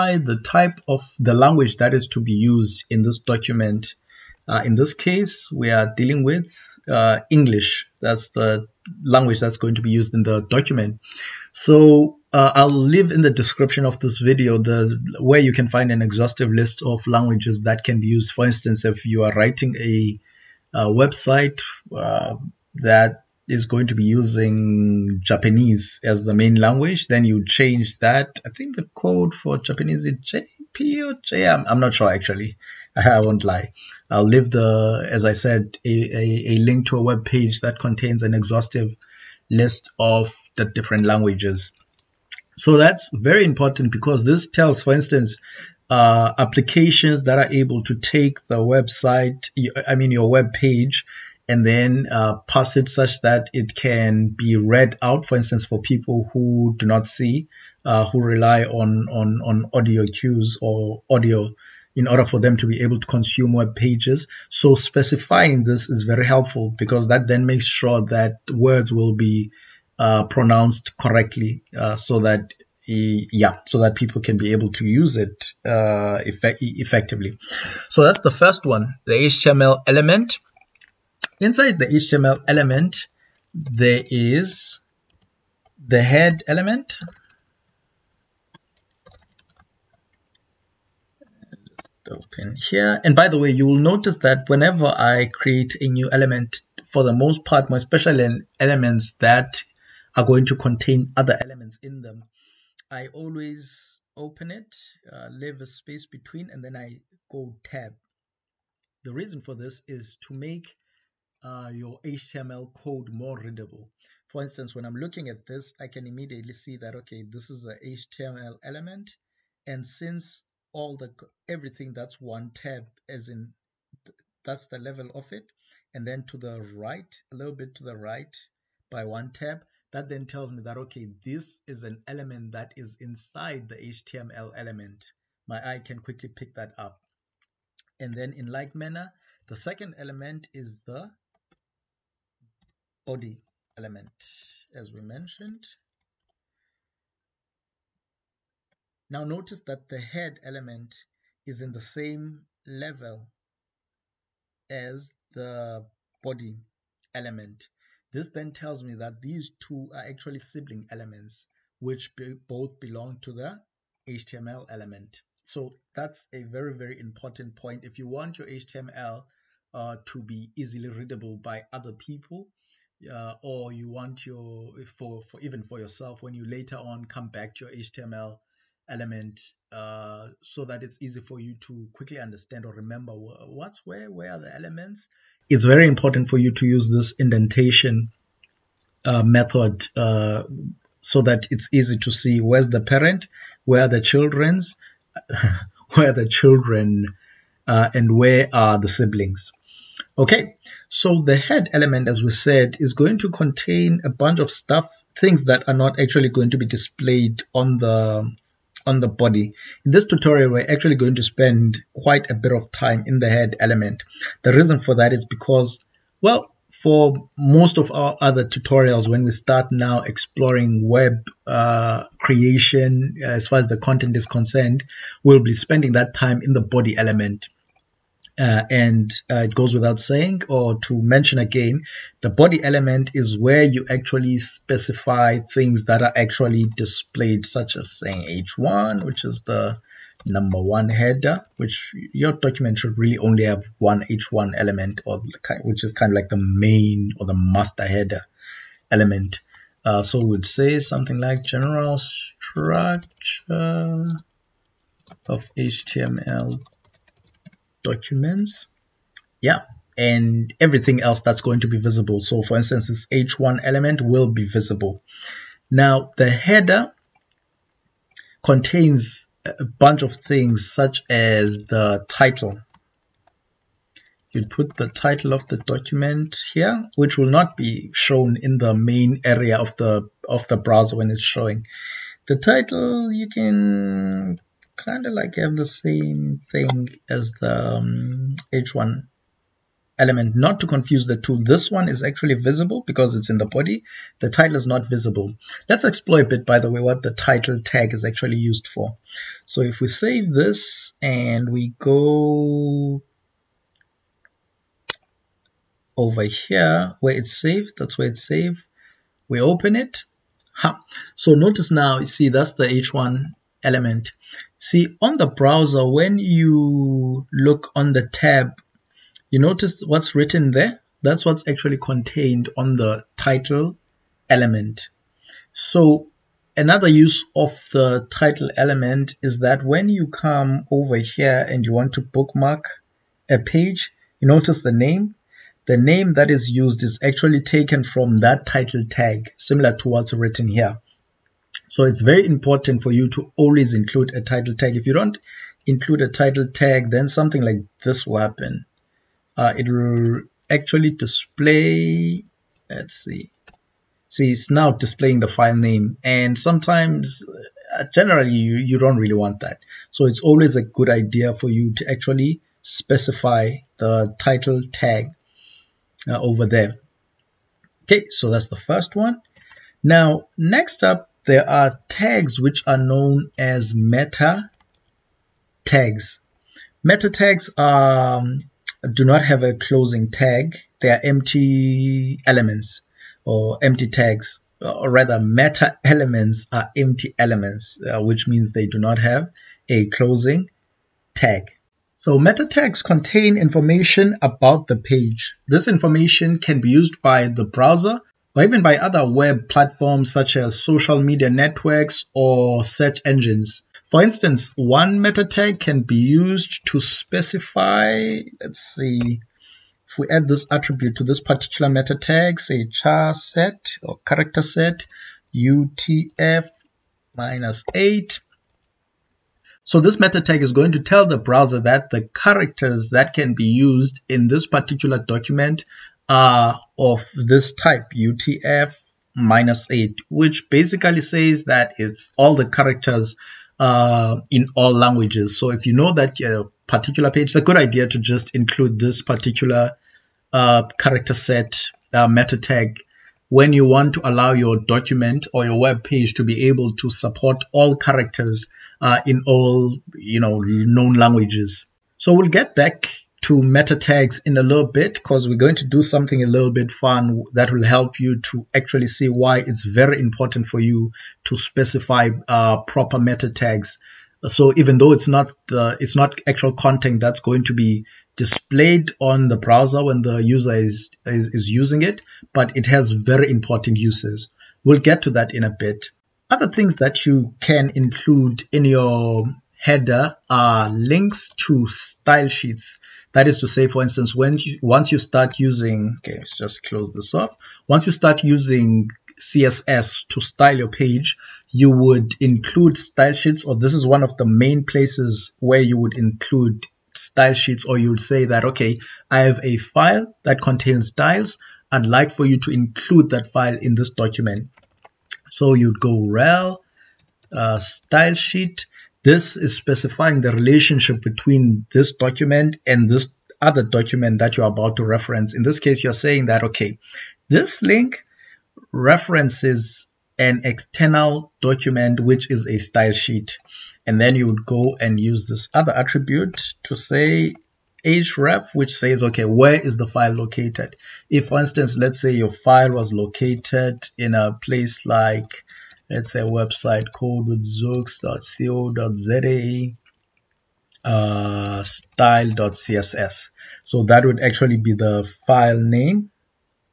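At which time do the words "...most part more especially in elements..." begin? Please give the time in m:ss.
1:37.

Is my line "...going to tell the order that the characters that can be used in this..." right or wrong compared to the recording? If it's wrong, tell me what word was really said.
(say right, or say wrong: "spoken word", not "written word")
wrong: "browser", not "order".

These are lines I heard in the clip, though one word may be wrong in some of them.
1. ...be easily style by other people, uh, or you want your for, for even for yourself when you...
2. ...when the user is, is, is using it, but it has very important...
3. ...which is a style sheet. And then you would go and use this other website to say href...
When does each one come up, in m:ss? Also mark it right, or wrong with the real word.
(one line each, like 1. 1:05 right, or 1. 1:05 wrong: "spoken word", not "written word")
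1. 2:50 wrong: "readable", not "style"
2. 7:49 right
3. 8:41 wrong: "attribute", not "website".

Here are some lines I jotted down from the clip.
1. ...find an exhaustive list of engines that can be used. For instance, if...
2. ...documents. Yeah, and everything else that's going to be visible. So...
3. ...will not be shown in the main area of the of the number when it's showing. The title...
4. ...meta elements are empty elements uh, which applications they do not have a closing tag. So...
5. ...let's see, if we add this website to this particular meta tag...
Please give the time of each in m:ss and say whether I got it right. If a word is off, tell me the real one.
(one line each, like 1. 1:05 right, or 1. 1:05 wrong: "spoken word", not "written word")
1. 0:15 wrong: "languages", not "engines"
2. 4:17 right
3. 4:37 wrong: "browser", not "number"
4. 6:25 wrong: "means", not "applications"
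5. 6:48 wrong: "attribute", not "website".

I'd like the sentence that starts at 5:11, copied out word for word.
so notice now you see that's the h1 element.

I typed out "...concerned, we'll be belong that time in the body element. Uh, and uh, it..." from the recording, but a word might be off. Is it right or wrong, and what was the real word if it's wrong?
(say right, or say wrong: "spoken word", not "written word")
wrong: "spending", not "belong".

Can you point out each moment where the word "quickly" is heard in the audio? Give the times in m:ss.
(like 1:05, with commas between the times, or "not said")
2:16, 3:01.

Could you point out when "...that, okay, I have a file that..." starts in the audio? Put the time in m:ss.
8:18.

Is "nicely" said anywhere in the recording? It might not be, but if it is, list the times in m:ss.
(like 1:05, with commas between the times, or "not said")
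not said.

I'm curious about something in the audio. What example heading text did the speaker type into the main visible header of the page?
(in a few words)
general structure of HTML documents.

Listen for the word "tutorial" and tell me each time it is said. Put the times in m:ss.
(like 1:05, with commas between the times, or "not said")
3:30, 3:38.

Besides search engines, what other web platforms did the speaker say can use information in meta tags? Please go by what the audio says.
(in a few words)
social media networks.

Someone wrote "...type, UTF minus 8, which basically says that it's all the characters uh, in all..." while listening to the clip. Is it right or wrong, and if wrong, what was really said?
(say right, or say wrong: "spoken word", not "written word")
right.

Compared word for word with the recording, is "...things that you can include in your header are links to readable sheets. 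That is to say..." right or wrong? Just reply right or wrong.
wrong.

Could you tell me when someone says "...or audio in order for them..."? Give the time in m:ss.
1:00.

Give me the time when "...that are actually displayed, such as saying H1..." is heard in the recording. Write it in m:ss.
3:55.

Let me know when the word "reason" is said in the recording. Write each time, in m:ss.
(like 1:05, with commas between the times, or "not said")
1:49, 3:34.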